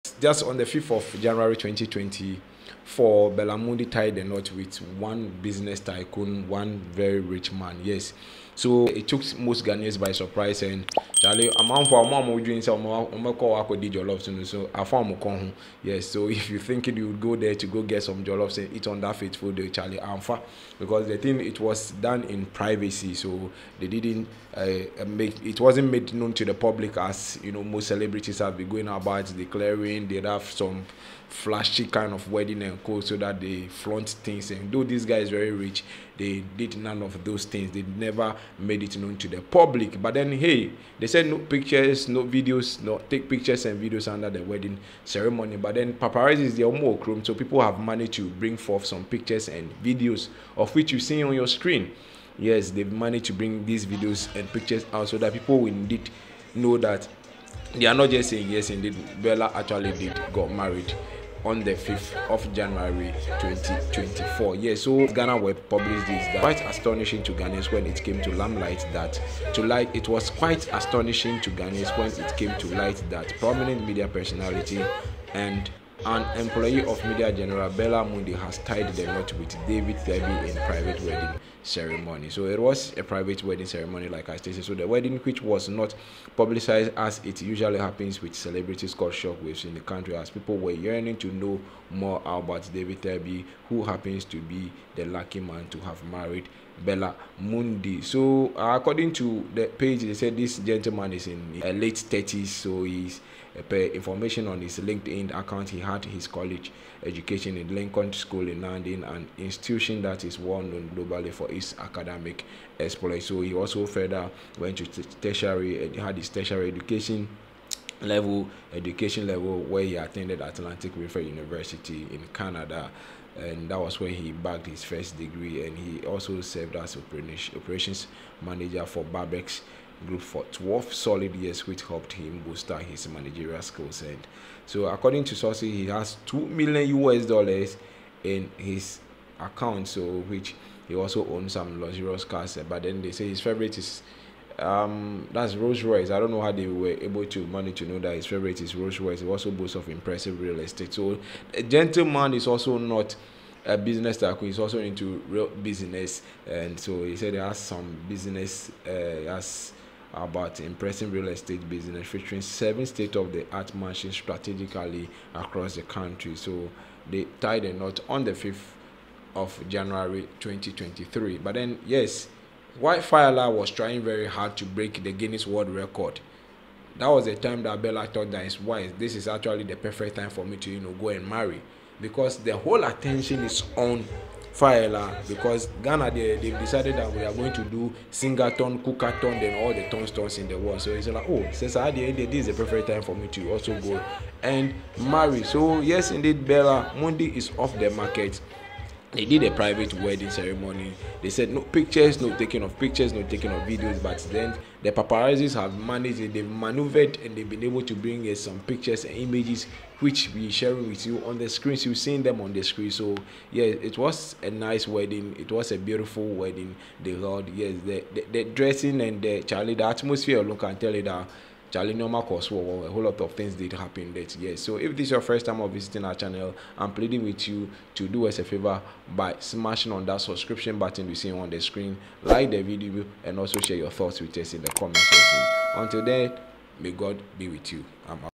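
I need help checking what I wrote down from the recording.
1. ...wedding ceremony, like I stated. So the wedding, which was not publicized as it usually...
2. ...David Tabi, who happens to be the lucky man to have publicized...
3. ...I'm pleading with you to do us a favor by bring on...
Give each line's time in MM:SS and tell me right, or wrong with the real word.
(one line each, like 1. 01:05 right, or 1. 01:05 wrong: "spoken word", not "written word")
1. 01:23 right
2. 01:32 wrong: "married", not "publicized"
3. 03:46 wrong: "smashing", not "bring".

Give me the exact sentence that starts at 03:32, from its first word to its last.
So yeah, it was a nice wedding.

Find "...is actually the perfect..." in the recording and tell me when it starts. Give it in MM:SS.
02:59.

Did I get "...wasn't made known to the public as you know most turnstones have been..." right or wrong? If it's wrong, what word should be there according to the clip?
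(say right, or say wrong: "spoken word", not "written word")
wrong: "celebrities", not "turnstones".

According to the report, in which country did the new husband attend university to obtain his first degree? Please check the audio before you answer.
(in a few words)
Canada.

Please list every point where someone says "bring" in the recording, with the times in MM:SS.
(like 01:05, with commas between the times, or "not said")
00:48, 00:53, 03:27.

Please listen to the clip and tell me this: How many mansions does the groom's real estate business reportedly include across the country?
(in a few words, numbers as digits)
7.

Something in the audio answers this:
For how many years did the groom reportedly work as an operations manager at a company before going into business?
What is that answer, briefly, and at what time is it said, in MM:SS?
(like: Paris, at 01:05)
12, at 02:10.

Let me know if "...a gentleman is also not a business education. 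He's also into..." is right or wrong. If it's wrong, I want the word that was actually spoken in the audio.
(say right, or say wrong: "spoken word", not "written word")
wrong: "tycoon", not "education".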